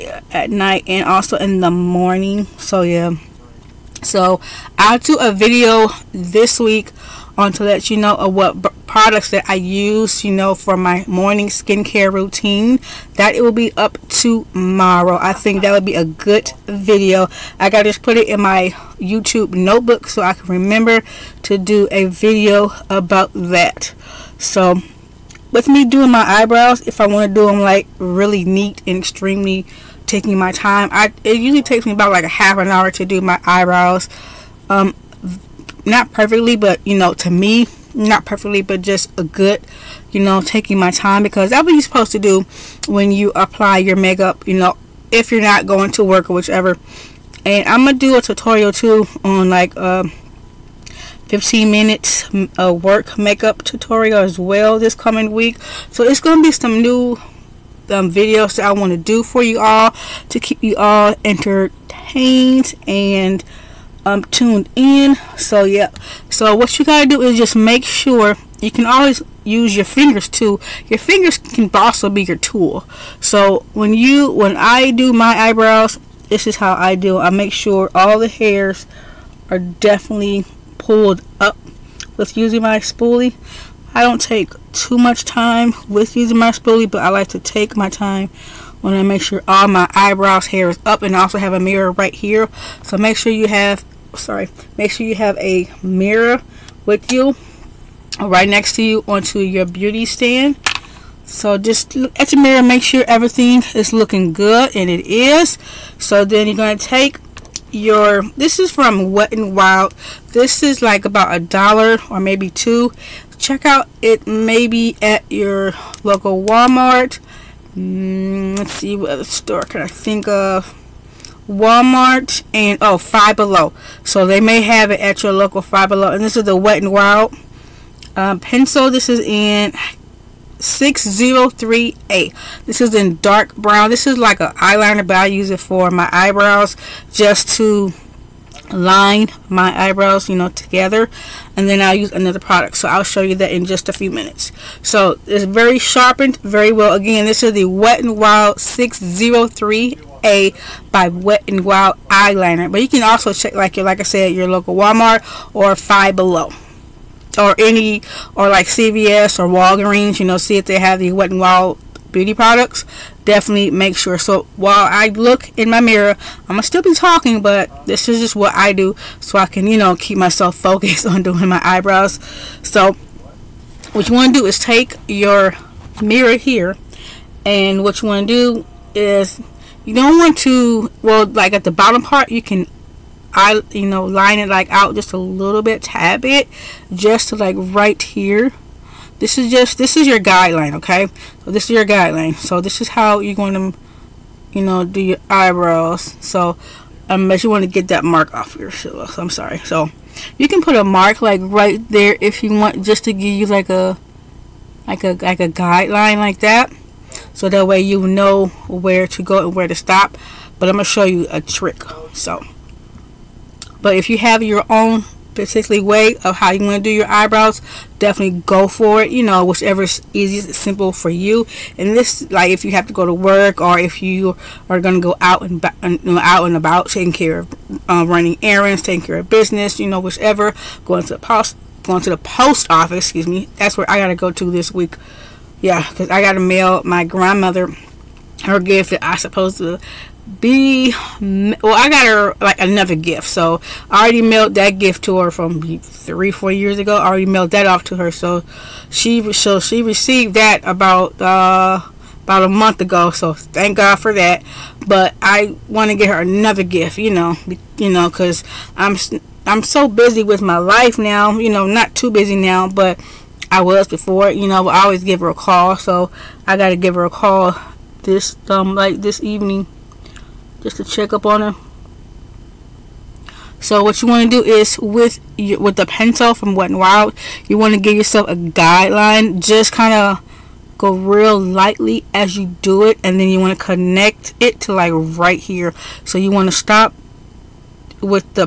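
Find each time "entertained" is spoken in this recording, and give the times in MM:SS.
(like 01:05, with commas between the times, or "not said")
01:01.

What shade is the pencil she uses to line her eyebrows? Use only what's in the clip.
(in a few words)
dark brown.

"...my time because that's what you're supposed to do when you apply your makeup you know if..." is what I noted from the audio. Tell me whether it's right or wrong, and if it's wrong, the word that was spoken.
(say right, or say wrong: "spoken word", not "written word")
right.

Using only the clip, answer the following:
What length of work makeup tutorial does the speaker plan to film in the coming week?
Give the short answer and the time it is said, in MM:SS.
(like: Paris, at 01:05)
15 minutes, at 00:51.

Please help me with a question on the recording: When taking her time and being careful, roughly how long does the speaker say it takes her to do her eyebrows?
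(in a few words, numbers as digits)
half an hour.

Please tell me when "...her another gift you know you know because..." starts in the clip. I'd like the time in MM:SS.
04:16.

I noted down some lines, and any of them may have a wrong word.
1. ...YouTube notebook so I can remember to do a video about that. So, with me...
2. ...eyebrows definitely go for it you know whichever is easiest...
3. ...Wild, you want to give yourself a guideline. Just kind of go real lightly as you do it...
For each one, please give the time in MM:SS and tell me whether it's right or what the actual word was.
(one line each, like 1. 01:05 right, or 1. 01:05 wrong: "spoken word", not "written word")
1. 00:18 right
2. 03:37 right
3. 04:36 right.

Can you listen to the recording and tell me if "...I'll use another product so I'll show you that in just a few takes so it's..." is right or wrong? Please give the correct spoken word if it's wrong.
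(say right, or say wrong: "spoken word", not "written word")
wrong: "minutes", not "takes".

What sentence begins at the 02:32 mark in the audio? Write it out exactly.
But you can also check, like like I said, your local Walmart or Five Below.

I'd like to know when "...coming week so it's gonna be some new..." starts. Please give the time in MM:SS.
00:54.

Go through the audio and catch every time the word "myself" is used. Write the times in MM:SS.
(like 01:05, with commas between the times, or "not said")
02:50.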